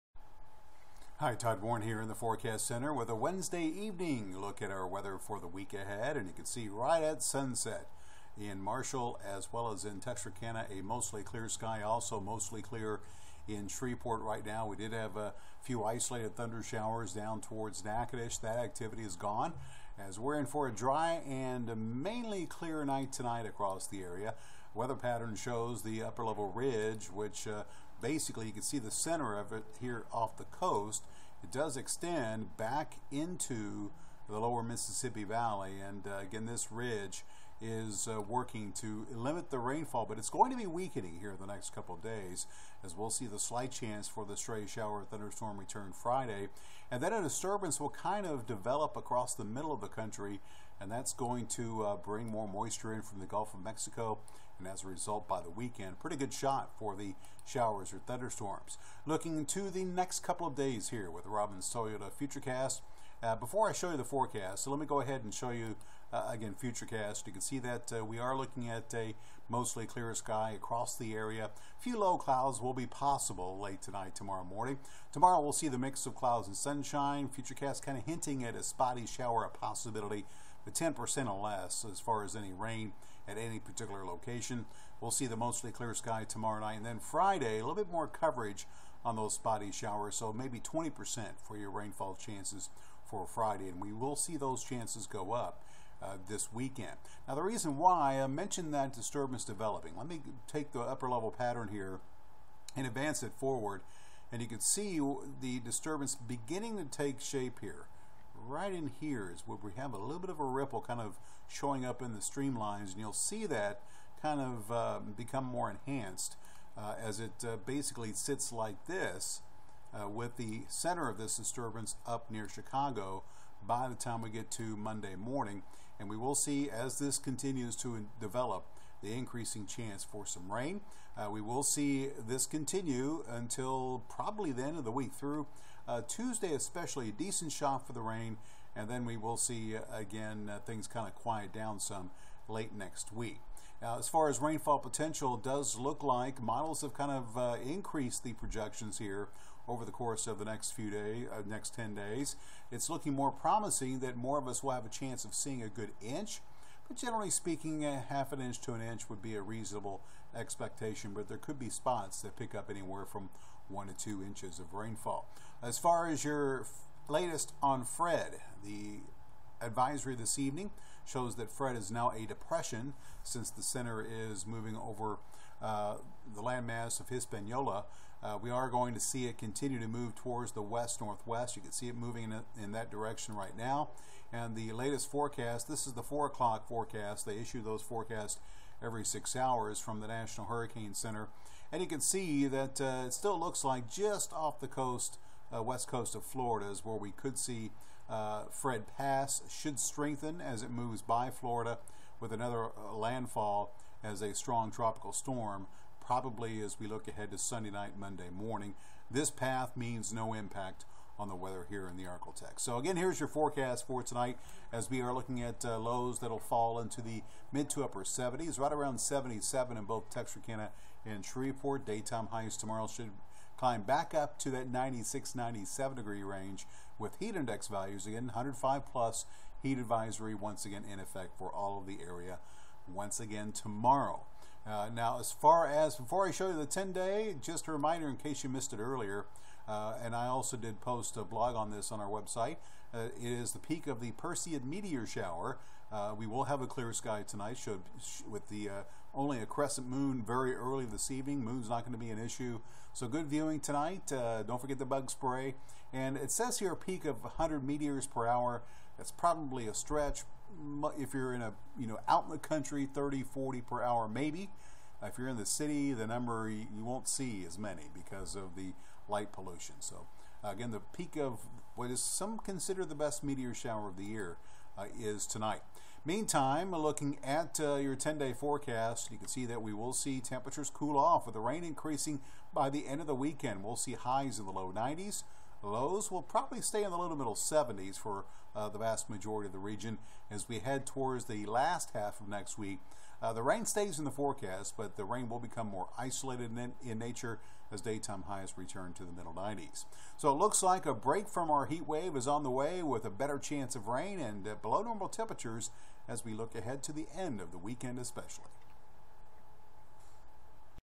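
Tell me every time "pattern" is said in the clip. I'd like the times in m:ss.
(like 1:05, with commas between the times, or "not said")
0:24, 1:41.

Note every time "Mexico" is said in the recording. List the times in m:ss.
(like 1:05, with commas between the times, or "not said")
0:53.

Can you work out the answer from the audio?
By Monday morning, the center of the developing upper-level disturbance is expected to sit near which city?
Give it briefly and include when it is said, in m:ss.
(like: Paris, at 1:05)
Chicago, at 2:02.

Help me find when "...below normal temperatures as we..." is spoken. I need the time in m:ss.
5:04.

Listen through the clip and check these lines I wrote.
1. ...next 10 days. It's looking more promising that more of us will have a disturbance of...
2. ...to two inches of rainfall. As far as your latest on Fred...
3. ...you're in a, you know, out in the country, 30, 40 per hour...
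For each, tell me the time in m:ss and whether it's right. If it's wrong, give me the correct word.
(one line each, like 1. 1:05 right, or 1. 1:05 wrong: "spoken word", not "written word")
1. 2:31 wrong: "chance", not "disturbance"
2. 2:43 right
3. 4:21 right.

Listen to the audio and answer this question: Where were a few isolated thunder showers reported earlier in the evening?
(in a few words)
Natchitoches.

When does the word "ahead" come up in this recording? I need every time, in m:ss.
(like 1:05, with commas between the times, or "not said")
0:05, 1:04, 3:27, 5:06.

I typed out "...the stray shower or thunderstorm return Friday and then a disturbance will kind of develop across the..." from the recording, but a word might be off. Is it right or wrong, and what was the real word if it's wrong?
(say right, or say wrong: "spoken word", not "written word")
right.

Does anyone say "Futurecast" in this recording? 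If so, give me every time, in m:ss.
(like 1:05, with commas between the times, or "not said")
1:02, 1:06, 1:17.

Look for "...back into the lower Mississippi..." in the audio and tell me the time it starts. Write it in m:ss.
0:32.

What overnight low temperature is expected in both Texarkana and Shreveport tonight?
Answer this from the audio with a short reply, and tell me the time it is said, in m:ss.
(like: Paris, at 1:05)
77, at 3:38.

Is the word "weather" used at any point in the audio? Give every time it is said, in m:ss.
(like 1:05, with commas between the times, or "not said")
0:04, 0:24, 3:31.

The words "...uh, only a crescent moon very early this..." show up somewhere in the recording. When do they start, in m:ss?
4:08.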